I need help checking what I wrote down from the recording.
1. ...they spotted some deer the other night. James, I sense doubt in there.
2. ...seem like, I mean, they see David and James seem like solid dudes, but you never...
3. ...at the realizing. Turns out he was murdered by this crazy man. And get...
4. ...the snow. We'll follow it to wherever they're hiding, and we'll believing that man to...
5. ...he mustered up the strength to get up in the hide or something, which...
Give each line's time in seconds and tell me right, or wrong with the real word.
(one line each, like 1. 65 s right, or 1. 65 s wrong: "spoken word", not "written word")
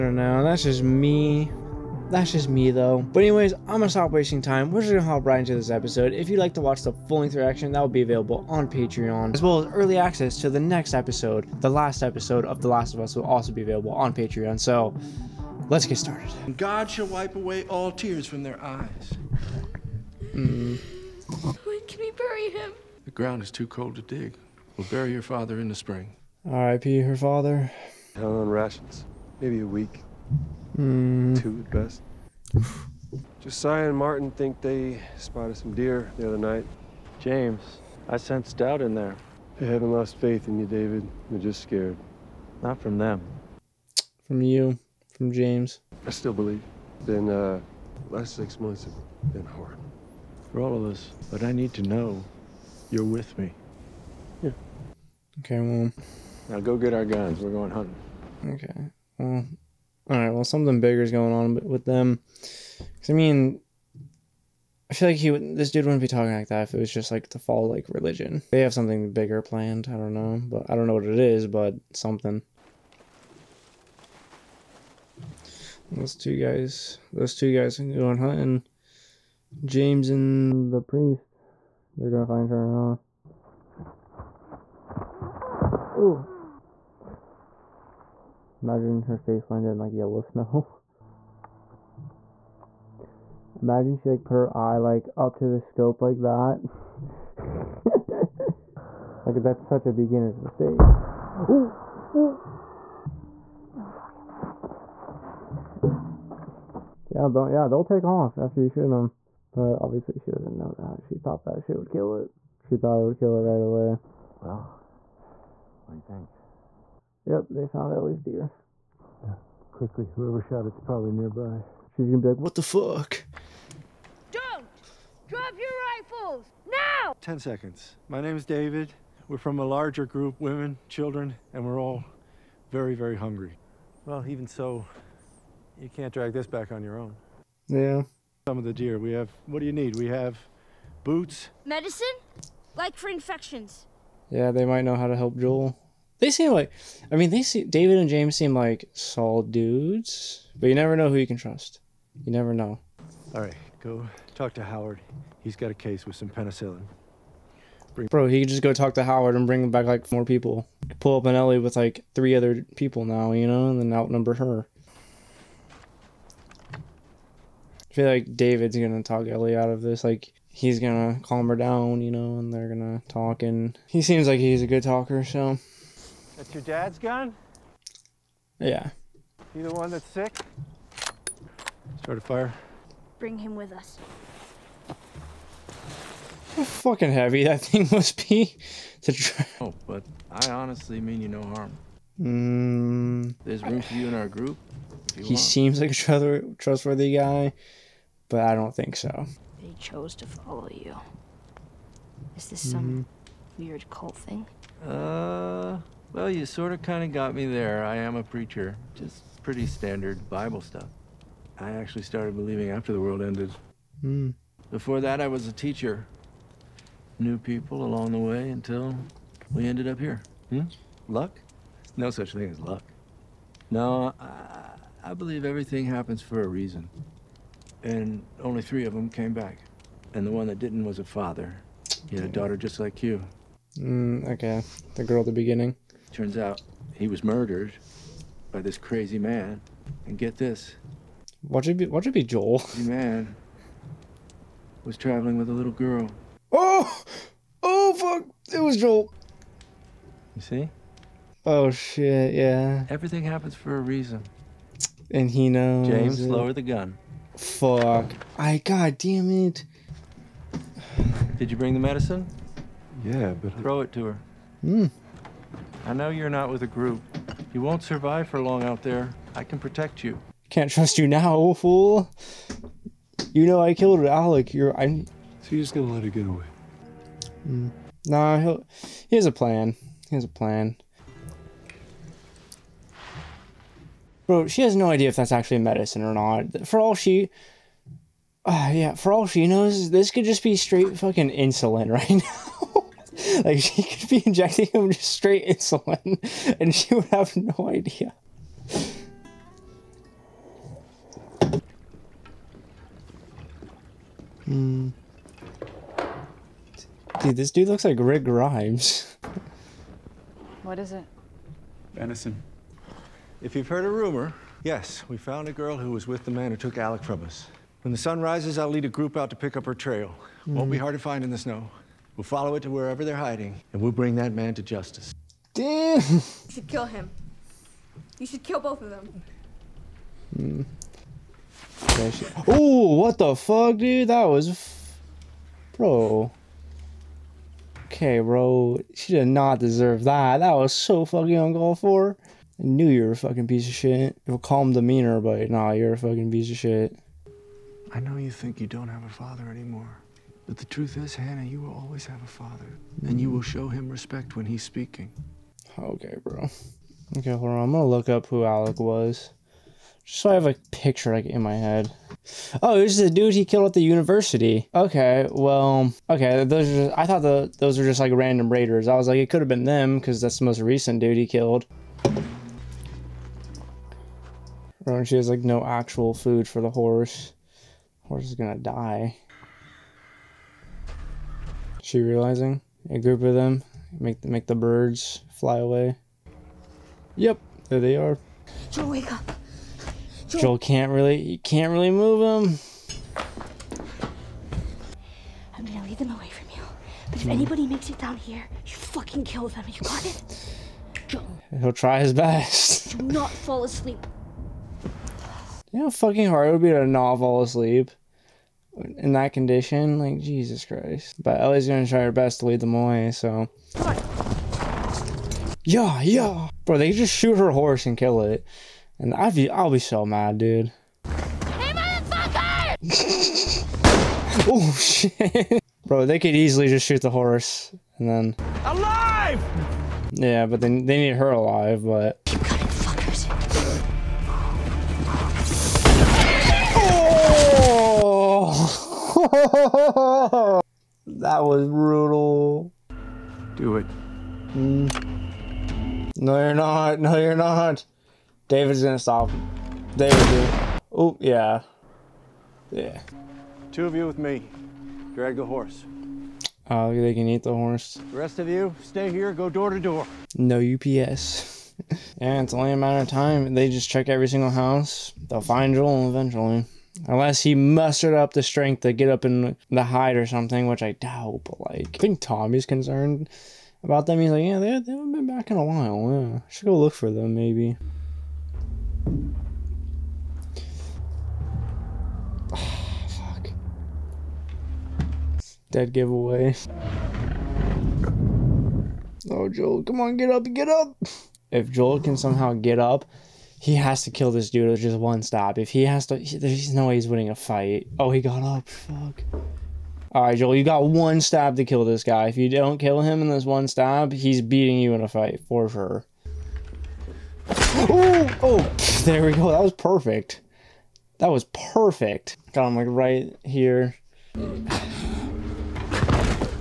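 1. 34 s right
2. 146 s right
3. 235 s wrong: "beginning", not "realizing"
4. 321 s wrong: "bring", not "believing"
5. 467 s right.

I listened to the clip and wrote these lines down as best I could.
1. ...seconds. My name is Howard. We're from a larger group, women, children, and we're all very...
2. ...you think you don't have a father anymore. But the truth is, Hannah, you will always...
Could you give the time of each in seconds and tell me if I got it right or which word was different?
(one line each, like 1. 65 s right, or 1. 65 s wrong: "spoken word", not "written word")
1. 127 s wrong: "David", not "Howard"
2. 348 s right.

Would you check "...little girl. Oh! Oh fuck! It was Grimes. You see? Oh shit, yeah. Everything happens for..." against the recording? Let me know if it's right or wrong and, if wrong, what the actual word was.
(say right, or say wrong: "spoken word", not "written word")
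wrong: "Joel", not "Grimes".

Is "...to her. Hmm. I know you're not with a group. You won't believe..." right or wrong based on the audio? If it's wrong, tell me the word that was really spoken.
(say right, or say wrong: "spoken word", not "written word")
wrong: "survive", not "believe".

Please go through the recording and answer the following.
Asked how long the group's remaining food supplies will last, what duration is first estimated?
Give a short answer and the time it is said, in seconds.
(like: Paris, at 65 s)
A week, at 29 s.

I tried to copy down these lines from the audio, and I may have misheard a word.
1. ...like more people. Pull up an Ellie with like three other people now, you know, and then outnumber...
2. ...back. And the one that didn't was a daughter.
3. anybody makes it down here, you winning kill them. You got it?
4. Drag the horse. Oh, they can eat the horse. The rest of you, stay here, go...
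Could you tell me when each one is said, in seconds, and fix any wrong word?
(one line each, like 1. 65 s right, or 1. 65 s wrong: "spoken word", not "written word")
1. 159 s right
2. 229 s wrong: "father", not "daughter"
3. 397 s wrong: "fucking", not "winning"
4. 455 s right.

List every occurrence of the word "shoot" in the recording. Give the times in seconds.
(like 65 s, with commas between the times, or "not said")
108 s, 417 s, 426 s.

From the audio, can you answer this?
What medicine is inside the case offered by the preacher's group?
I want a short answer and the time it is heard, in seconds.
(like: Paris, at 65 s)
Penicillin, at 156 s.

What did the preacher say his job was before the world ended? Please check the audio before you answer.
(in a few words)
Teacher.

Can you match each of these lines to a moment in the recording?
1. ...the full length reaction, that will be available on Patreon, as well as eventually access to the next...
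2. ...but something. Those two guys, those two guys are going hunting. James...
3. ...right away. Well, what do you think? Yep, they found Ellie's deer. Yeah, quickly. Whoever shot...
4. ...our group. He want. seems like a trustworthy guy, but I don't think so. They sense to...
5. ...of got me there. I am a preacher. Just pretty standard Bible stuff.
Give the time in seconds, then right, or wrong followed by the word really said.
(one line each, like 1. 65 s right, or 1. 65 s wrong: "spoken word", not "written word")
1. 6 s wrong: "early", not "eventually"
2. 71 s right
3. 113 s right
4. 194 s wrong: "chose", not "sense"
5. 207 s right.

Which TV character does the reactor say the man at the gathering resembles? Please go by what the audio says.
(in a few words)
Rick Grimes.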